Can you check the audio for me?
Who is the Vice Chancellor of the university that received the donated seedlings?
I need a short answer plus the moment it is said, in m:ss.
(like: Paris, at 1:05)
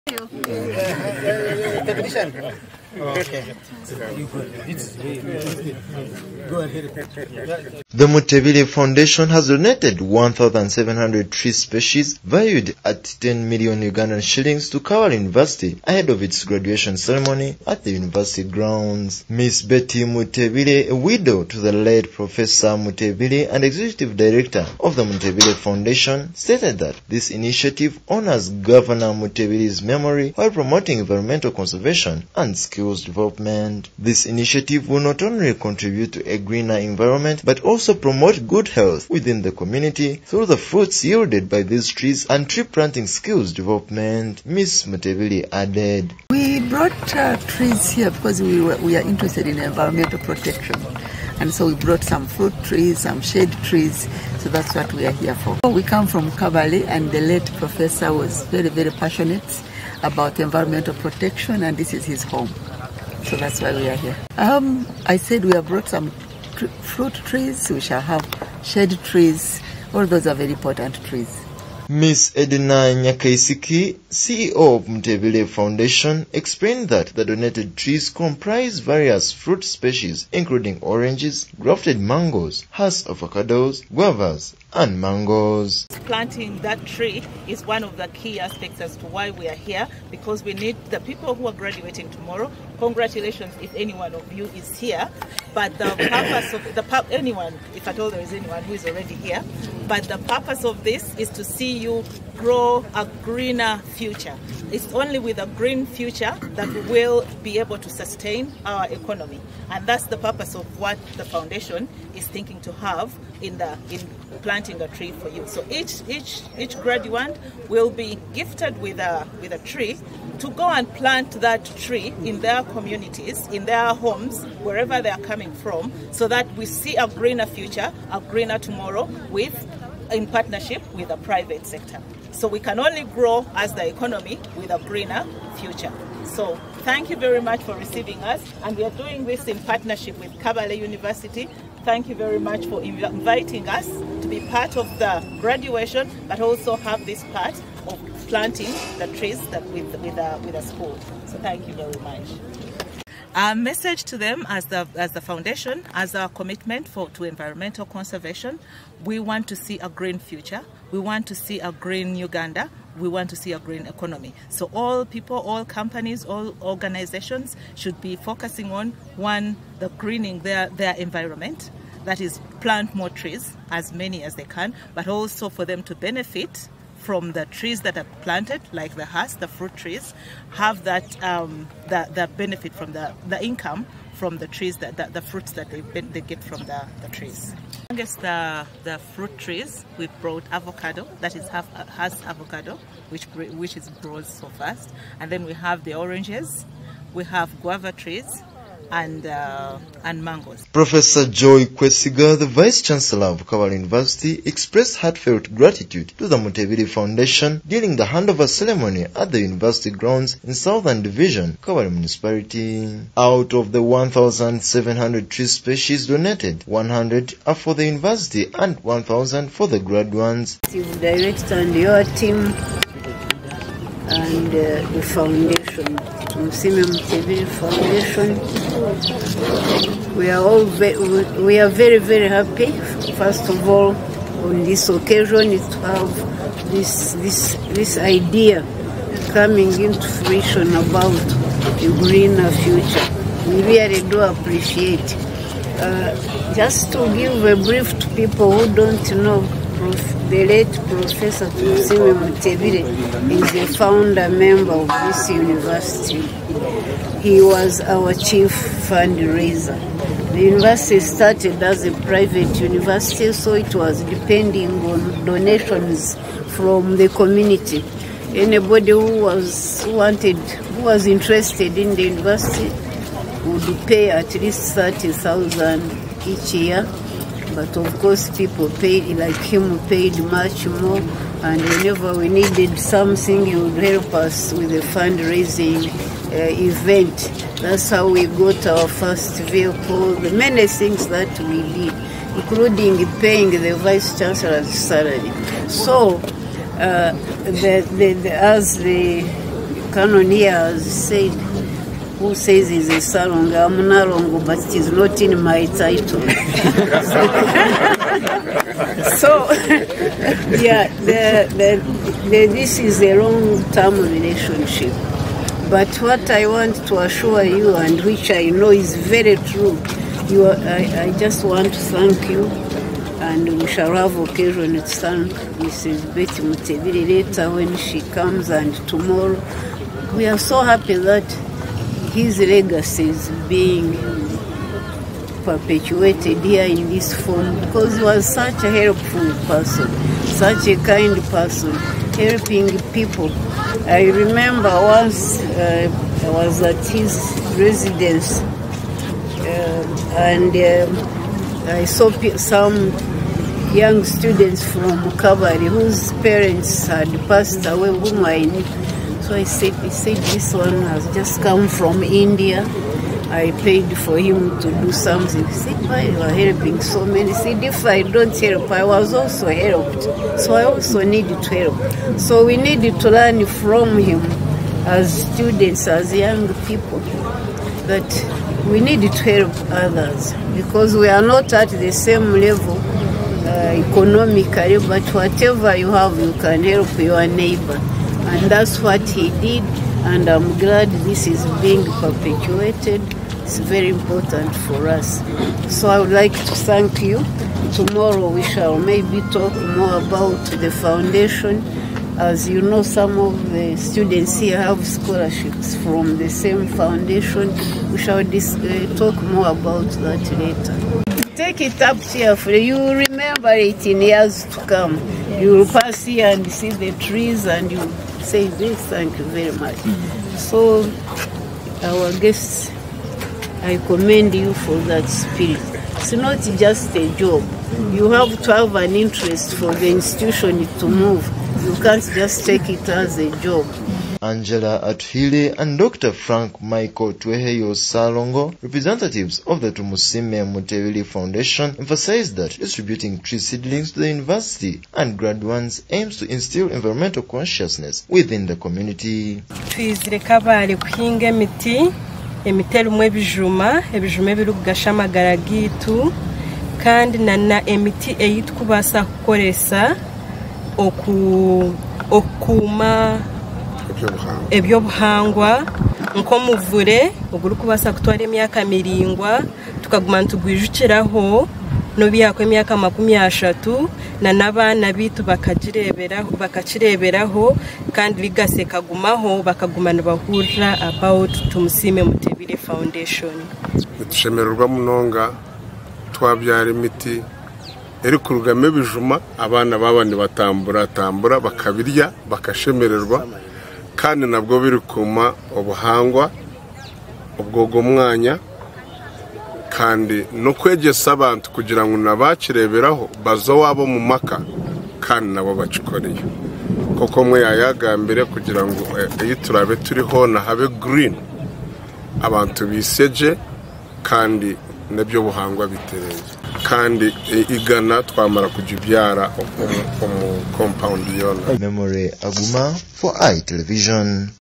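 Joy Kwesiga, at 3:21.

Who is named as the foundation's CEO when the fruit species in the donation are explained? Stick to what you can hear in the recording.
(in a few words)
Edina Nyakaisiki.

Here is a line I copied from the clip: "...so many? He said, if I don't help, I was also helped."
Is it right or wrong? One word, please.
right.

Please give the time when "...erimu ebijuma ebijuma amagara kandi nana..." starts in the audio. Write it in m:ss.
7:32.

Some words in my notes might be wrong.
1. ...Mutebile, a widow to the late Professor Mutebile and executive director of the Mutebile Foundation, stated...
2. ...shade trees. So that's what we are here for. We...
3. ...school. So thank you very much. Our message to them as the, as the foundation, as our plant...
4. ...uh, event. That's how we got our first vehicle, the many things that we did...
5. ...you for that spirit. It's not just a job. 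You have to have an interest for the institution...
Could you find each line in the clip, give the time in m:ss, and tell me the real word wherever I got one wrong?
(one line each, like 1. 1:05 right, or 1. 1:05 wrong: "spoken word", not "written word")
1. 0:20 right
2. 0:53 right
3. 2:30 wrong: "commitment", not "plant"
4. 4:46 right
5. 7:04 right.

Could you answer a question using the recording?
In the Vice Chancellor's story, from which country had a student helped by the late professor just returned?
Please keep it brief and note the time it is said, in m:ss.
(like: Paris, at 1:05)
India, at 6:02.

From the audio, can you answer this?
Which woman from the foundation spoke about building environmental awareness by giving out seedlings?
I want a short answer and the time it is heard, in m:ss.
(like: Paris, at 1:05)
Angela Atuhili, at 7:14.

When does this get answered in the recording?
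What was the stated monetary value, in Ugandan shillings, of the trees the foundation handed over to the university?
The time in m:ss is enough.
0:13.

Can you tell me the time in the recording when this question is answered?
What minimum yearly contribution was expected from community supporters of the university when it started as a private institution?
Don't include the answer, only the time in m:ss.
4:34.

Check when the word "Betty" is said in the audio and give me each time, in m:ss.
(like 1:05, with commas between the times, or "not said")
0:19, 5:26.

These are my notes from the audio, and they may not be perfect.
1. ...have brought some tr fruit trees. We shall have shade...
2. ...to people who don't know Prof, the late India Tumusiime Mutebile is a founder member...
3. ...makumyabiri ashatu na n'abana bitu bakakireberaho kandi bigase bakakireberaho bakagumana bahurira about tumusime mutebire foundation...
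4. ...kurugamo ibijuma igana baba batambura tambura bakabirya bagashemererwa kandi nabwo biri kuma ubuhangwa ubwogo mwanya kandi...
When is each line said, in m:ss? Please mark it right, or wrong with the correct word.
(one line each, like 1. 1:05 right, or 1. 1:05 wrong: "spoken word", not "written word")
1. 1:05 right
2. 4:07 wrong: "Professor", not "India"
3. 7:52 wrong: "kagumaho", not "bakakireberaho"
4. 8:08 wrong: "abana", not "igana".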